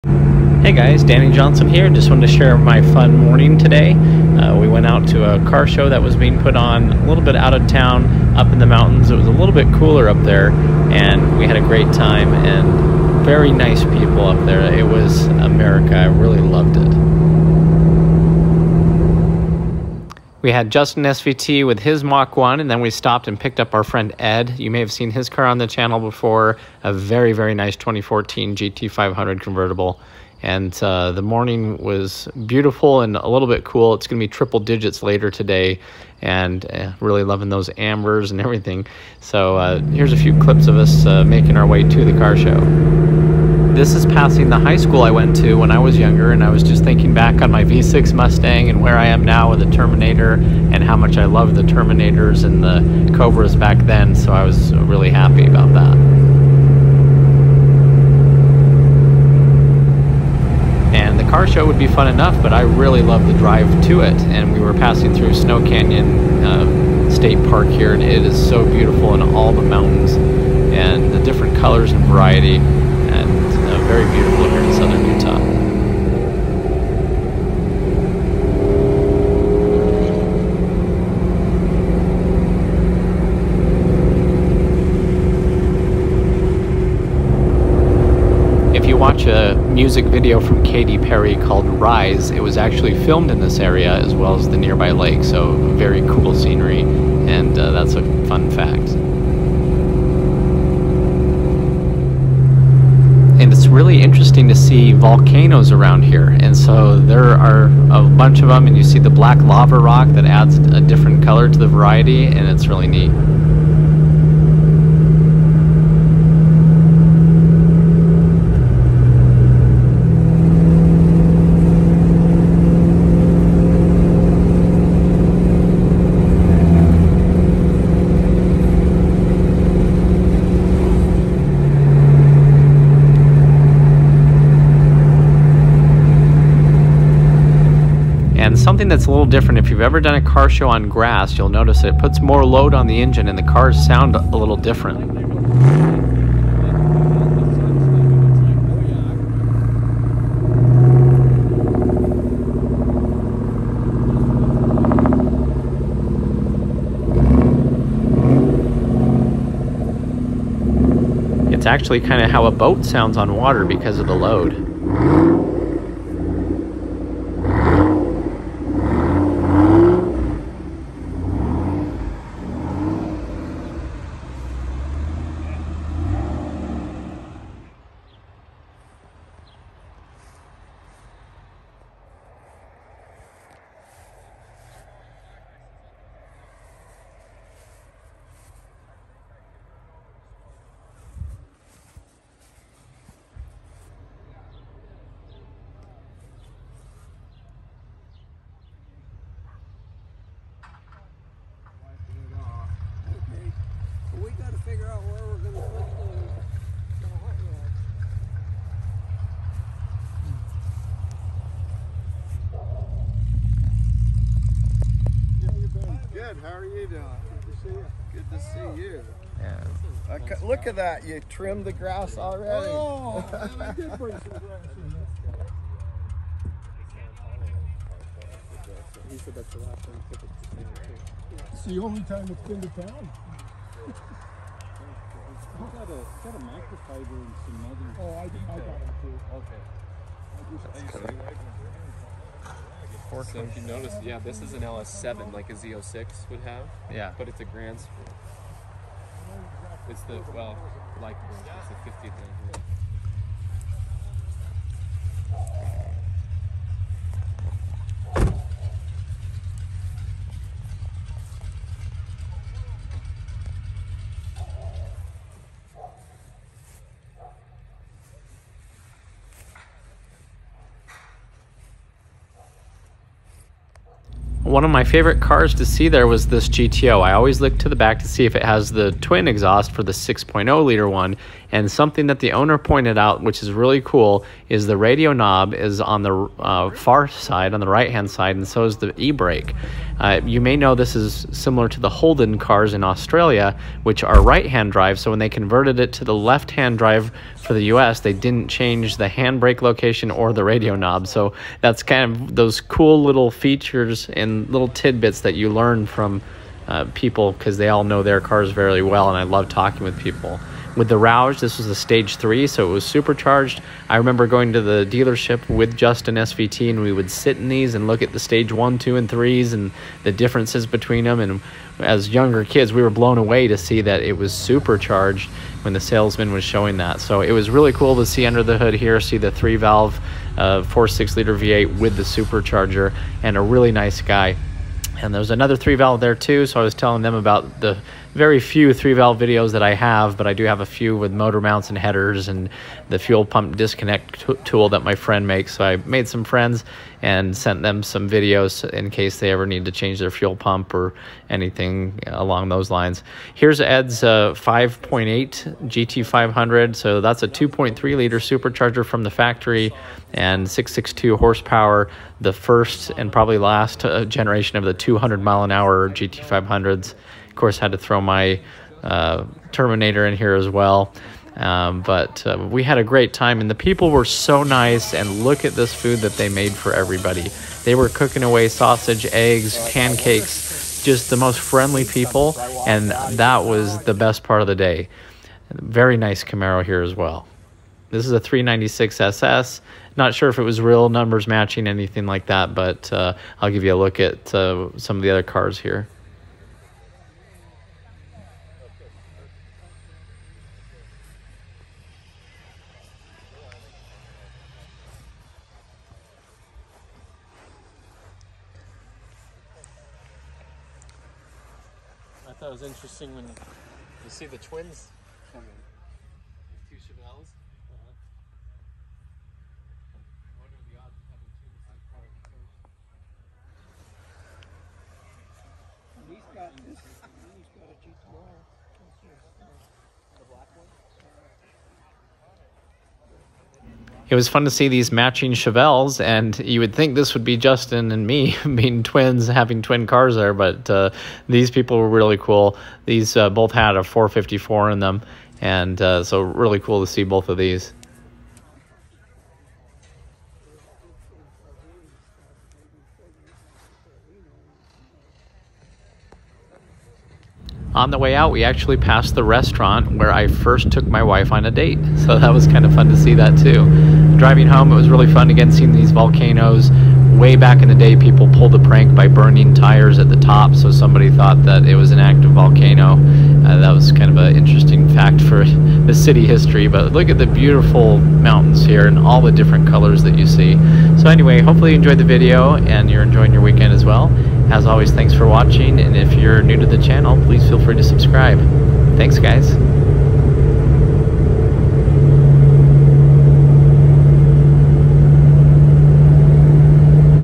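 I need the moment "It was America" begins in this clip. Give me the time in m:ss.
0:14.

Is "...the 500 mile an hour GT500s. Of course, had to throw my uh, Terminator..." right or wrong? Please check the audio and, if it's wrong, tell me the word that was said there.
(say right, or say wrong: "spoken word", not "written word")
wrong: "200", not "500".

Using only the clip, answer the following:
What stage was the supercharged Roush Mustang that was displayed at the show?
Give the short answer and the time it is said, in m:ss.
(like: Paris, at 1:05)
stage three, at 5:11.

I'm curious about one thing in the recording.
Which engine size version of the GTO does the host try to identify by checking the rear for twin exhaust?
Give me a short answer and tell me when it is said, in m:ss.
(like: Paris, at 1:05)
6.0 liter, at 4:39.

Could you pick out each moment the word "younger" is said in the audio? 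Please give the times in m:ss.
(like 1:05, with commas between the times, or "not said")
0:45, 5:22.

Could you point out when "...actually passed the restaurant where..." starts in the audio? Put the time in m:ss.
7:38.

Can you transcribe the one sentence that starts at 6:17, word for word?
They were cooking away sausage, eggs, pancakes, just the most friendly people.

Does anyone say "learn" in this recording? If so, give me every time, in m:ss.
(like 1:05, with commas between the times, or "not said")
5:05.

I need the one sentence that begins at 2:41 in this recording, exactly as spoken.
It's actually kind of how a boat sounds on water because of the load.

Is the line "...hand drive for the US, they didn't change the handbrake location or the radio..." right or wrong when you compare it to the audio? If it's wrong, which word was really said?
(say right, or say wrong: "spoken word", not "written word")
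right.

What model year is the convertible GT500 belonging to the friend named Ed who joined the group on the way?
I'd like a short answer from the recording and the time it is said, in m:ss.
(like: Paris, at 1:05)
2014, at 0:27.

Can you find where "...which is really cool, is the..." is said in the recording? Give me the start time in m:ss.
4:43.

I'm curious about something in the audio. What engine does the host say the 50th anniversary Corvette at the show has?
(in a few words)
LS7.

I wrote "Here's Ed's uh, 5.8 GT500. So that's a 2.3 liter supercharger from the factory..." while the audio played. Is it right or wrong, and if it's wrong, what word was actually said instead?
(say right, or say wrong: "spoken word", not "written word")
right.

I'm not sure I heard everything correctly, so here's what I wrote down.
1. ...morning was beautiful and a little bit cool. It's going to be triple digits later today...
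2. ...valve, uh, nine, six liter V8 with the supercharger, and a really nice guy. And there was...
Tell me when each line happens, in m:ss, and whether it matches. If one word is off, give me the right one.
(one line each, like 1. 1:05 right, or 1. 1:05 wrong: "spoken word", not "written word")
1. 0:31 right
2. 5:29 wrong: "four", not "nine".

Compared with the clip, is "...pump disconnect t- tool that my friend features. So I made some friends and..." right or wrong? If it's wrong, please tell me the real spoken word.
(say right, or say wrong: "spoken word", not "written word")
wrong: "makes", not "features".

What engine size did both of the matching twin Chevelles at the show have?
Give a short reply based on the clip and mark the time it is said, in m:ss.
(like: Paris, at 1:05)
454, at 7:23.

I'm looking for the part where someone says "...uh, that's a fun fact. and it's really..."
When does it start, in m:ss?
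1:37.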